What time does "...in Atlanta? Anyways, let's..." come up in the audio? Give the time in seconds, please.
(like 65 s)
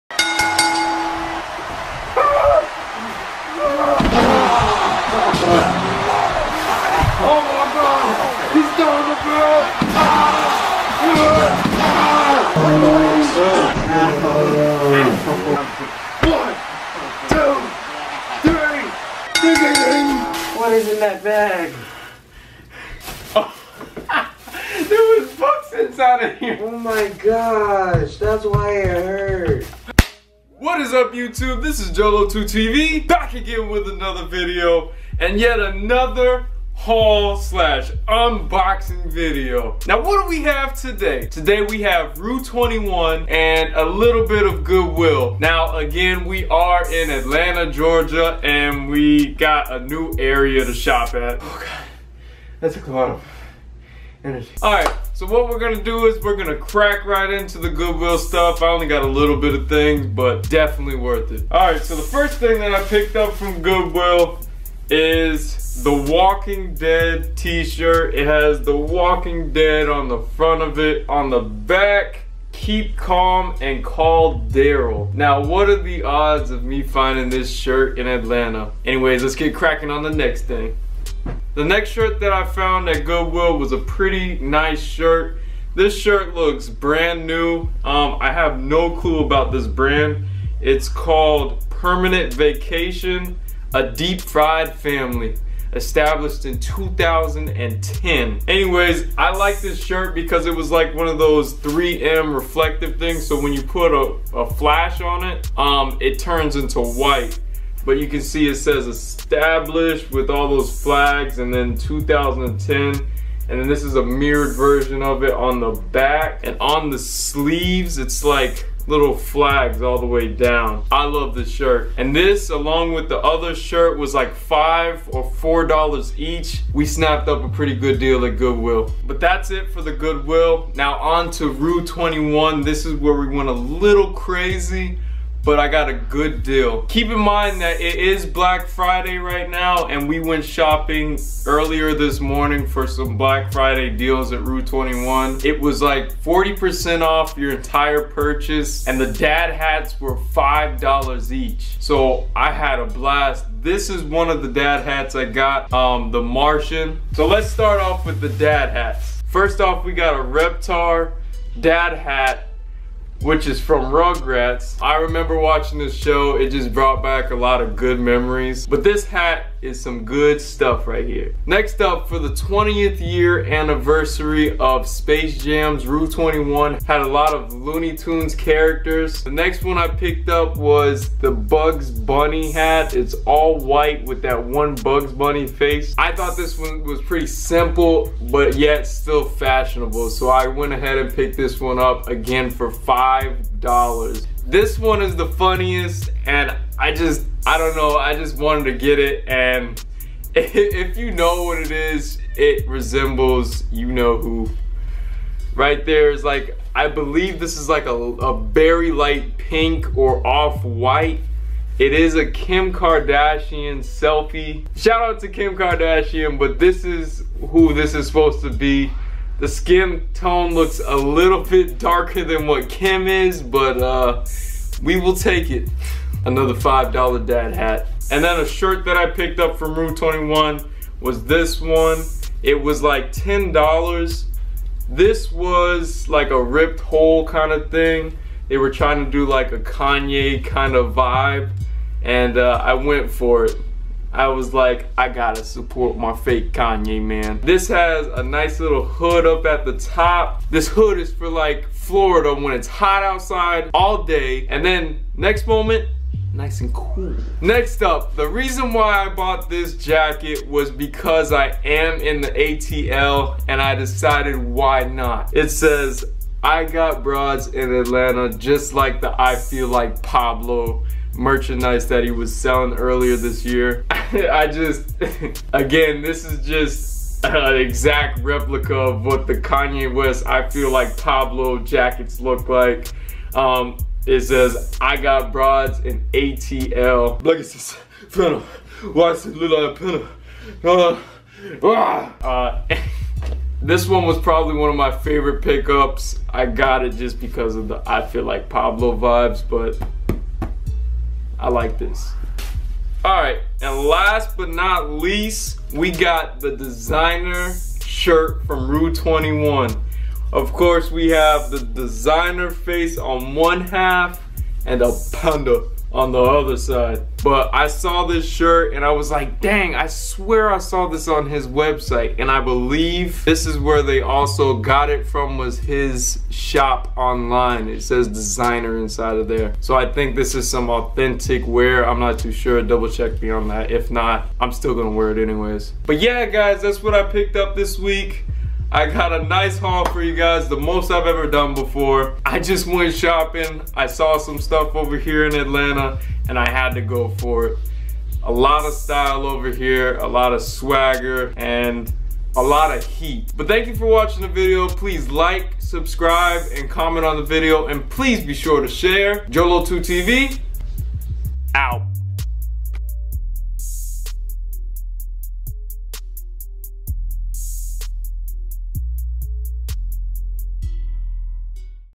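77 s.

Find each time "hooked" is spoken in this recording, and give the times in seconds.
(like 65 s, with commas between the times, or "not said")
not said.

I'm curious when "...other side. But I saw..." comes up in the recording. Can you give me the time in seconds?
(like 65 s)
316 s.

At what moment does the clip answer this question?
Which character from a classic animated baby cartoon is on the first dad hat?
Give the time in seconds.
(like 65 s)
160 s.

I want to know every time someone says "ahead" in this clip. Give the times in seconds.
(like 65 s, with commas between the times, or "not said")
190 s.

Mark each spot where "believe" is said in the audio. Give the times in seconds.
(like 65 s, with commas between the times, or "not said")
206 s, 322 s.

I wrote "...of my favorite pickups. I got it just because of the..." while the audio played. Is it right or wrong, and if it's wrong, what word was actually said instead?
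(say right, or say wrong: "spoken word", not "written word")
right.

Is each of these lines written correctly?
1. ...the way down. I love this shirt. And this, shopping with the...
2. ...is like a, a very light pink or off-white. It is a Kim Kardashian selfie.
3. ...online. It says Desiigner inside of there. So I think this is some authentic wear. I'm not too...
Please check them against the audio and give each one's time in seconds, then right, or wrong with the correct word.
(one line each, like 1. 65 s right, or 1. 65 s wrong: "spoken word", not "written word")
1. 119 s wrong: "along", not "shopping"
2. 207 s right
3. 326 s right.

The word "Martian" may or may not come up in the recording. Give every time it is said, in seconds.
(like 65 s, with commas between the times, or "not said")
156 s.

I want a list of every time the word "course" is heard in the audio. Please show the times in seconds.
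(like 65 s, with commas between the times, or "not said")
310 s.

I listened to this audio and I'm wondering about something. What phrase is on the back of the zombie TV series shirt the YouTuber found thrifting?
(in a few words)
Keep calm and call Daryl.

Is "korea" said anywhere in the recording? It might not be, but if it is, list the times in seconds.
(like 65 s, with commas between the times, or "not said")
not said.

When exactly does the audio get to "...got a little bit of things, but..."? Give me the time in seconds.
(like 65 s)
58 s.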